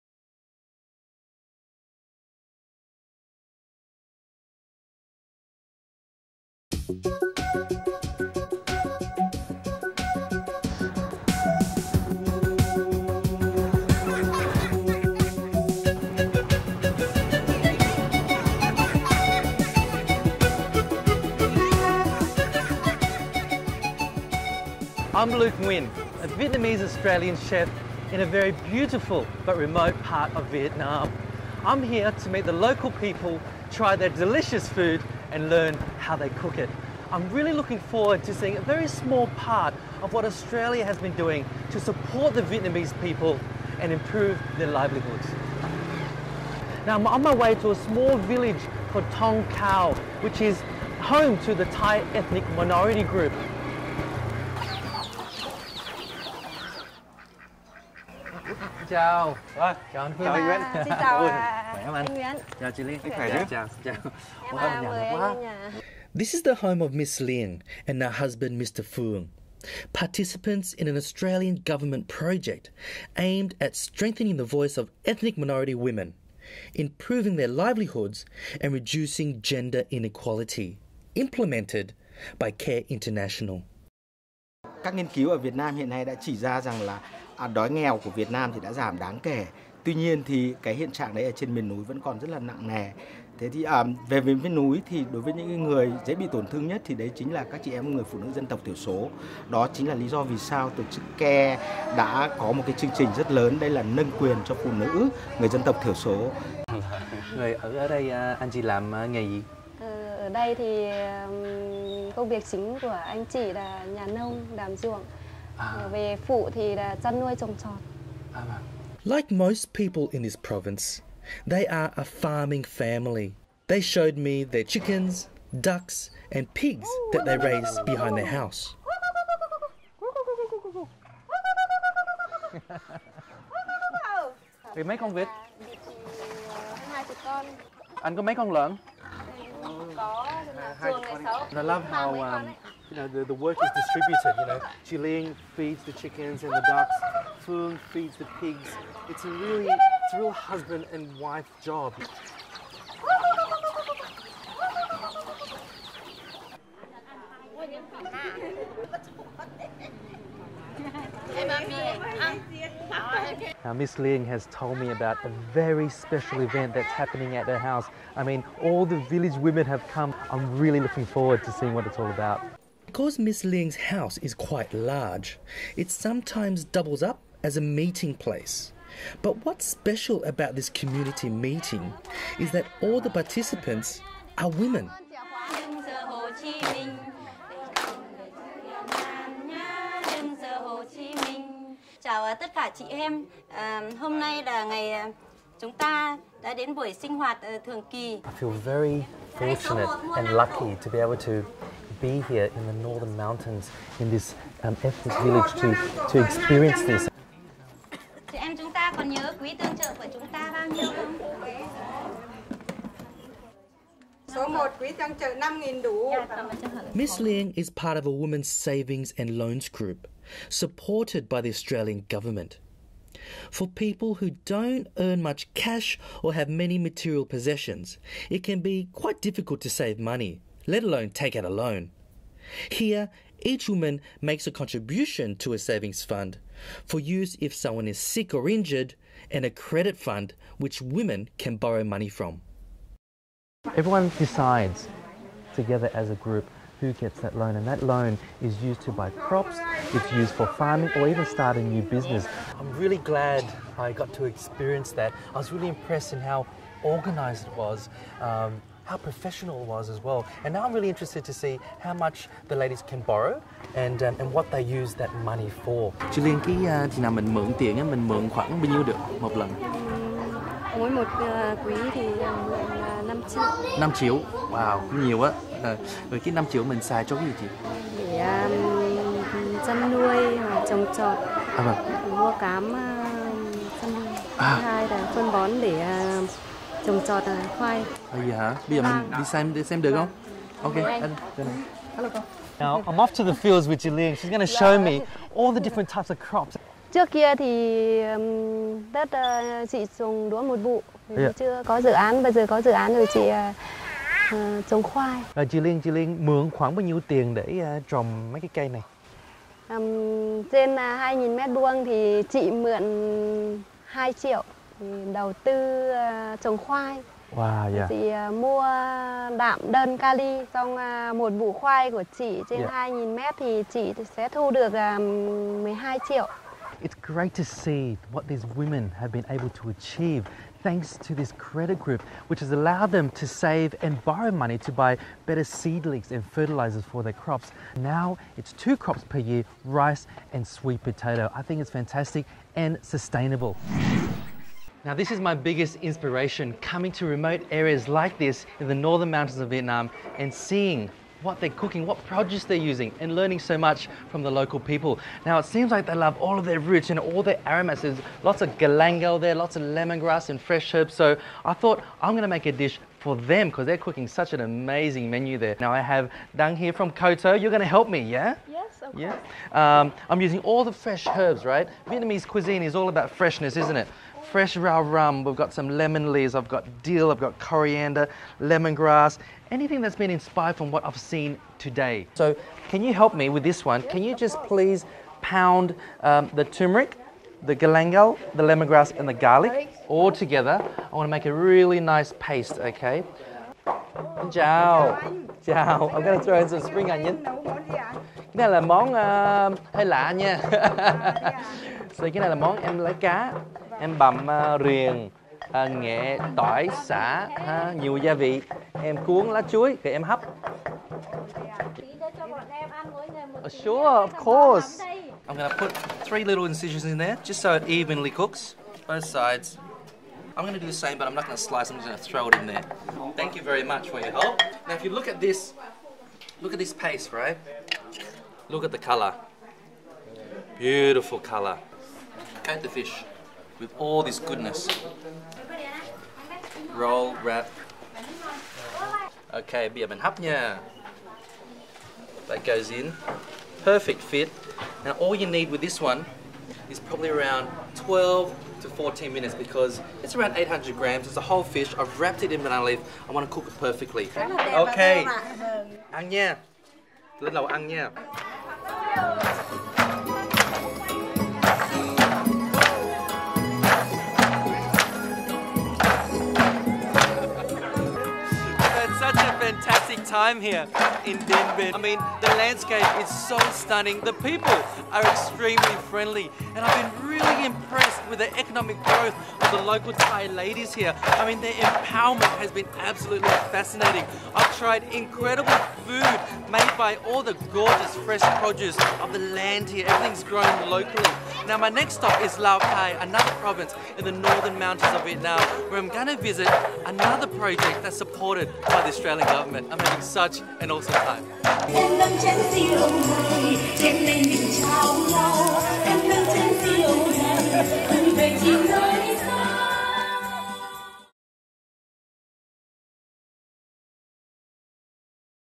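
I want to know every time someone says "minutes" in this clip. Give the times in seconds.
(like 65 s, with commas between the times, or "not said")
449 s.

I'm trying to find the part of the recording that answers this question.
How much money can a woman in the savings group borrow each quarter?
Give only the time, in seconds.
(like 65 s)
273 s.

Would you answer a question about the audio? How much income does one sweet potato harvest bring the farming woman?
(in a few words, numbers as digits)
12 million.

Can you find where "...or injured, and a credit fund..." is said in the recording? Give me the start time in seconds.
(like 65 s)
238 s.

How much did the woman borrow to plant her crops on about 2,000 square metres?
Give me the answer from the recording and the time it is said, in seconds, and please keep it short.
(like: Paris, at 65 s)
2 million, at 313 s.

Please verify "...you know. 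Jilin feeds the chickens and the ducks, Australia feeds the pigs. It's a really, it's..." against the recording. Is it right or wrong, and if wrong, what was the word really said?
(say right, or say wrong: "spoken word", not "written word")
wrong: "Fulun", not "Australia".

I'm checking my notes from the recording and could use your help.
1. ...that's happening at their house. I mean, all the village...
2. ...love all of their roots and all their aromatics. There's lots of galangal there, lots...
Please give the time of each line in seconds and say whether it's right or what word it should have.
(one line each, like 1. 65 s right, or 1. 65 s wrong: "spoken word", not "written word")
1. 166 s right
2. 355 s right.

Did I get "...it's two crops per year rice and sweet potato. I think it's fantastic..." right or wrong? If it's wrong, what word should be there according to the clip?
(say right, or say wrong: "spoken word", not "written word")
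right.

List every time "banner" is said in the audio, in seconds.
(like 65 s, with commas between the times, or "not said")
not said.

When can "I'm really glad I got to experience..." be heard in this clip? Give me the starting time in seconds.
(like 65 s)
252 s.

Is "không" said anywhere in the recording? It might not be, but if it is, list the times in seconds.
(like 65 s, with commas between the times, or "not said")
61 s, 289 s.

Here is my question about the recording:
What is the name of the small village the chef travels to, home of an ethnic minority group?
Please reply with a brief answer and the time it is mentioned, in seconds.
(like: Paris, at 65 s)
Tong Khao, at 49 s.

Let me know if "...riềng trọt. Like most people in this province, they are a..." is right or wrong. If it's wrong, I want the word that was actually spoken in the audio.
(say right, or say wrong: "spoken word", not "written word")
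wrong: "trồng", not "riềng".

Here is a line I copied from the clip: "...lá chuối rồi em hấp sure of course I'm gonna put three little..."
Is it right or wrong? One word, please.
right.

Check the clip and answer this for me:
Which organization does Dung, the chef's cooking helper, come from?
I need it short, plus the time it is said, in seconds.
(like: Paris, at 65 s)
Koto, at 366 s.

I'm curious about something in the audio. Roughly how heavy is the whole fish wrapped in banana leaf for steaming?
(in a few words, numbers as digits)
800 grams.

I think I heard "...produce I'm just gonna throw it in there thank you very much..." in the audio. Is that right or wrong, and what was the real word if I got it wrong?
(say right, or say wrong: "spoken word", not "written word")
wrong: "slice", not "produce".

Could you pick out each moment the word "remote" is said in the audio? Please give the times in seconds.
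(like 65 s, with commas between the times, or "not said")
29 s, 347 s.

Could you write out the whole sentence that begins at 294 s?
She's going to show me all the different types of crops.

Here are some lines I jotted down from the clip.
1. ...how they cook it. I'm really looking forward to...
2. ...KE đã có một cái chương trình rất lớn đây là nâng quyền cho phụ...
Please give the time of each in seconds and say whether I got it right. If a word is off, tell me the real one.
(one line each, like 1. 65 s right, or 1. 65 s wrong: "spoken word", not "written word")
1. 35 s right
2. 101 s right.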